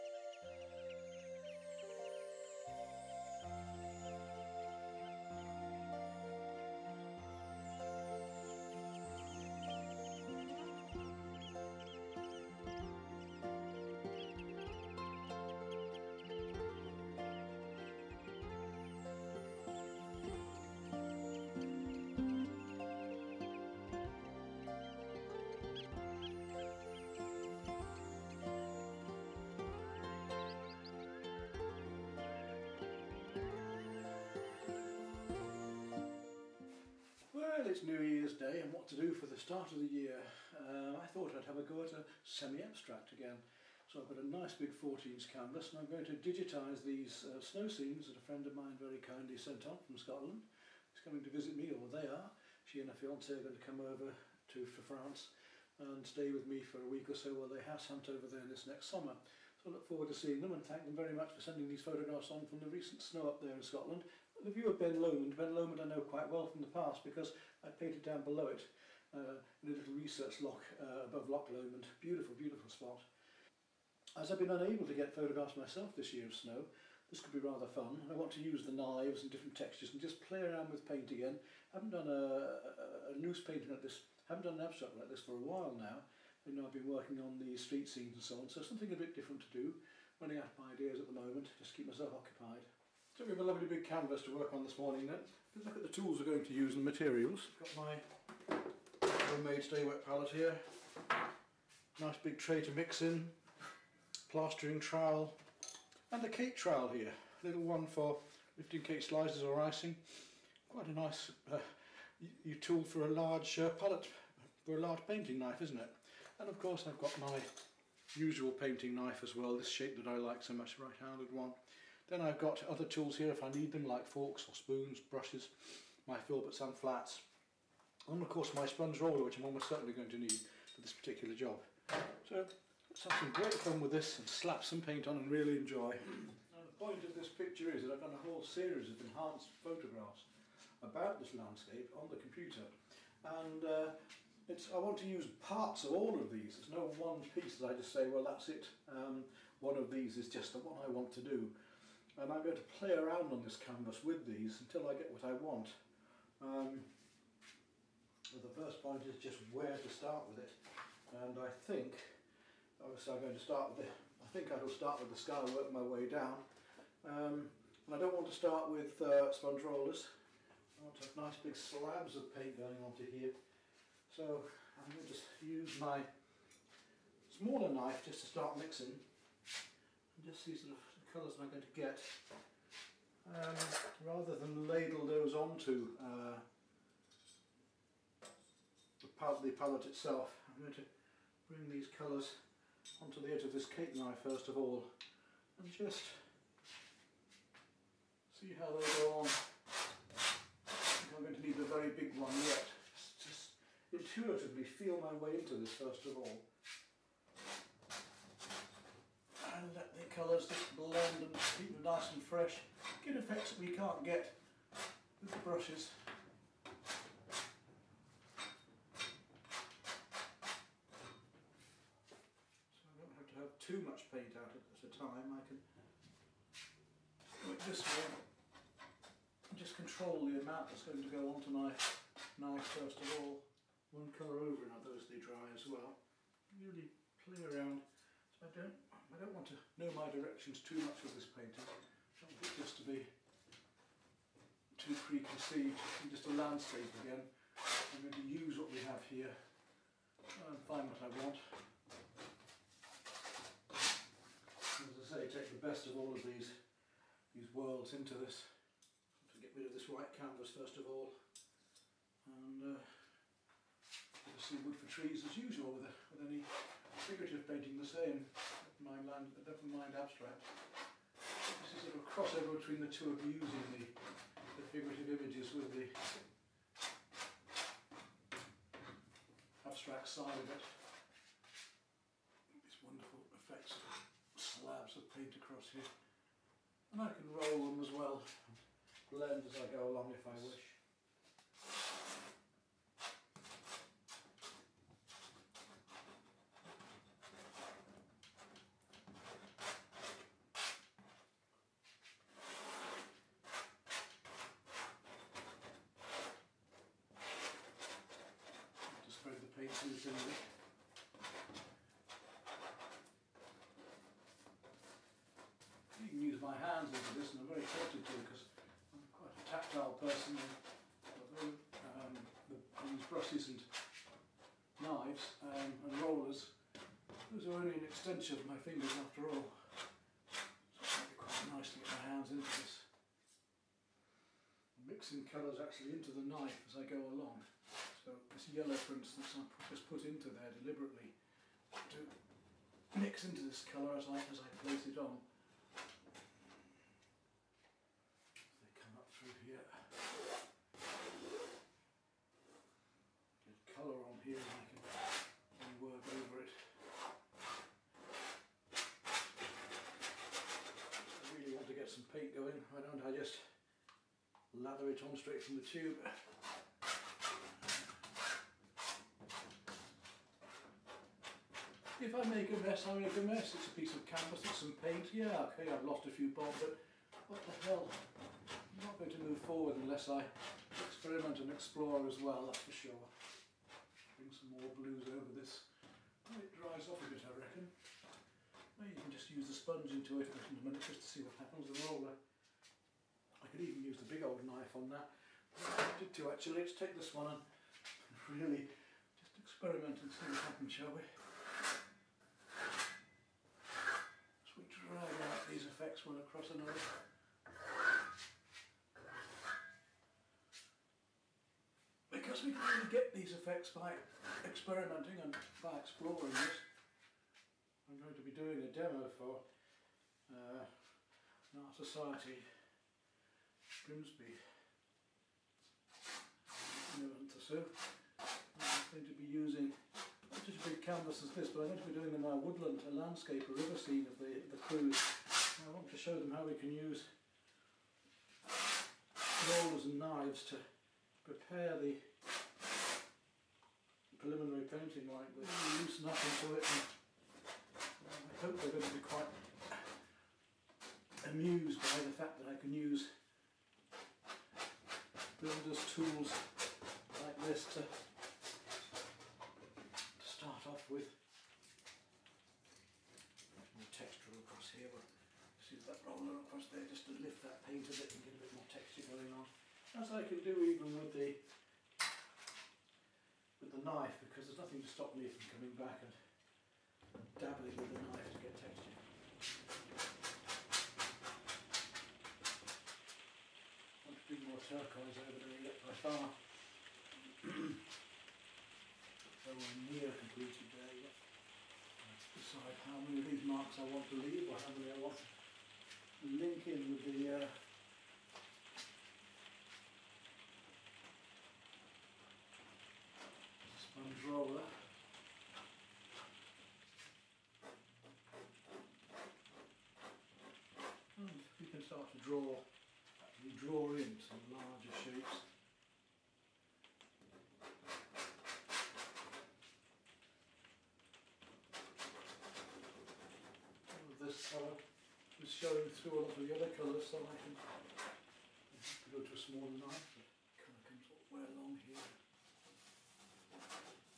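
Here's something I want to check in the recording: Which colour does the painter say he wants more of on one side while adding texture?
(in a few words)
turquoise.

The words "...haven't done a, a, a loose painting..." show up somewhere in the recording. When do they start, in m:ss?
1:21.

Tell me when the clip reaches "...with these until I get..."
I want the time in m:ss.
2:34.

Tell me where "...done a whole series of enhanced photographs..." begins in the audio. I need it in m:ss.
2:17.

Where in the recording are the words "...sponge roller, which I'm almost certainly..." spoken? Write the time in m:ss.
2:08.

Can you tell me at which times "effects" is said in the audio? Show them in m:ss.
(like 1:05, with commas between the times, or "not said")
3:33, 4:43, 6:45, 6:53.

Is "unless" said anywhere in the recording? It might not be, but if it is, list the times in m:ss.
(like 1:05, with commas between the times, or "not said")
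6:19.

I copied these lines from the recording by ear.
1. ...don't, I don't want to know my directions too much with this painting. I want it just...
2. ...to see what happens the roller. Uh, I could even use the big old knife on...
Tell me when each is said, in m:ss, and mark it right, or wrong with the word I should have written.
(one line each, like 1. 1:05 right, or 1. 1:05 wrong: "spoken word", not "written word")
1. 3:58 right
2. 6:30 right.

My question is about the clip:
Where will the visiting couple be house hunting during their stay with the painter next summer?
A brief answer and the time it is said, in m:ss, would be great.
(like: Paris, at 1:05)
France, at 0:54.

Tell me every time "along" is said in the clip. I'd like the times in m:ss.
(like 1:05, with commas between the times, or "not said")
4:49, 8:51.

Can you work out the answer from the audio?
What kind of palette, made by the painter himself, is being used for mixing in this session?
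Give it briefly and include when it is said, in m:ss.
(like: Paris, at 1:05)
stay wet palette, at 1:39.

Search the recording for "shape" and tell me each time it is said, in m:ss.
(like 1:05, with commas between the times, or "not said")
1:59, 8:34.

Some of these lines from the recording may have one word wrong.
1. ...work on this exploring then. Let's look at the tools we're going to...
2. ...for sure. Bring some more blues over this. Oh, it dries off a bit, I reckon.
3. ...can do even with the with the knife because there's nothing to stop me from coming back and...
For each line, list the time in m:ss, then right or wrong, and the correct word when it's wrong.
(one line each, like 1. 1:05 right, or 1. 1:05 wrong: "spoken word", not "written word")
1. 1:34 wrong: "morning", not "exploring"
2. 6:22 right
3. 7:50 right.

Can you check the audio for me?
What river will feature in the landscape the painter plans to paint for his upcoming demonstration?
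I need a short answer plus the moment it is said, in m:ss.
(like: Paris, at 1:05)
the Creuse, at 7:14.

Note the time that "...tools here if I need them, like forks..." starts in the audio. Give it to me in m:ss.
2:02.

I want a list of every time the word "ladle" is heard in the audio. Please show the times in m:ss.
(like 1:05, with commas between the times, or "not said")
3:04.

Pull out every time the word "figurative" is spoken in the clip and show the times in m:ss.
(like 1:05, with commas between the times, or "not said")
4:26, 4:34.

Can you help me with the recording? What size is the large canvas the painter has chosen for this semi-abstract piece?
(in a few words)
14s.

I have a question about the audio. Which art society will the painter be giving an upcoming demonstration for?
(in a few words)
Art Society Grimsby.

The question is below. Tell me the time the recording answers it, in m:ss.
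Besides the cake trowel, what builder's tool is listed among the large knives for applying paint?
1:44.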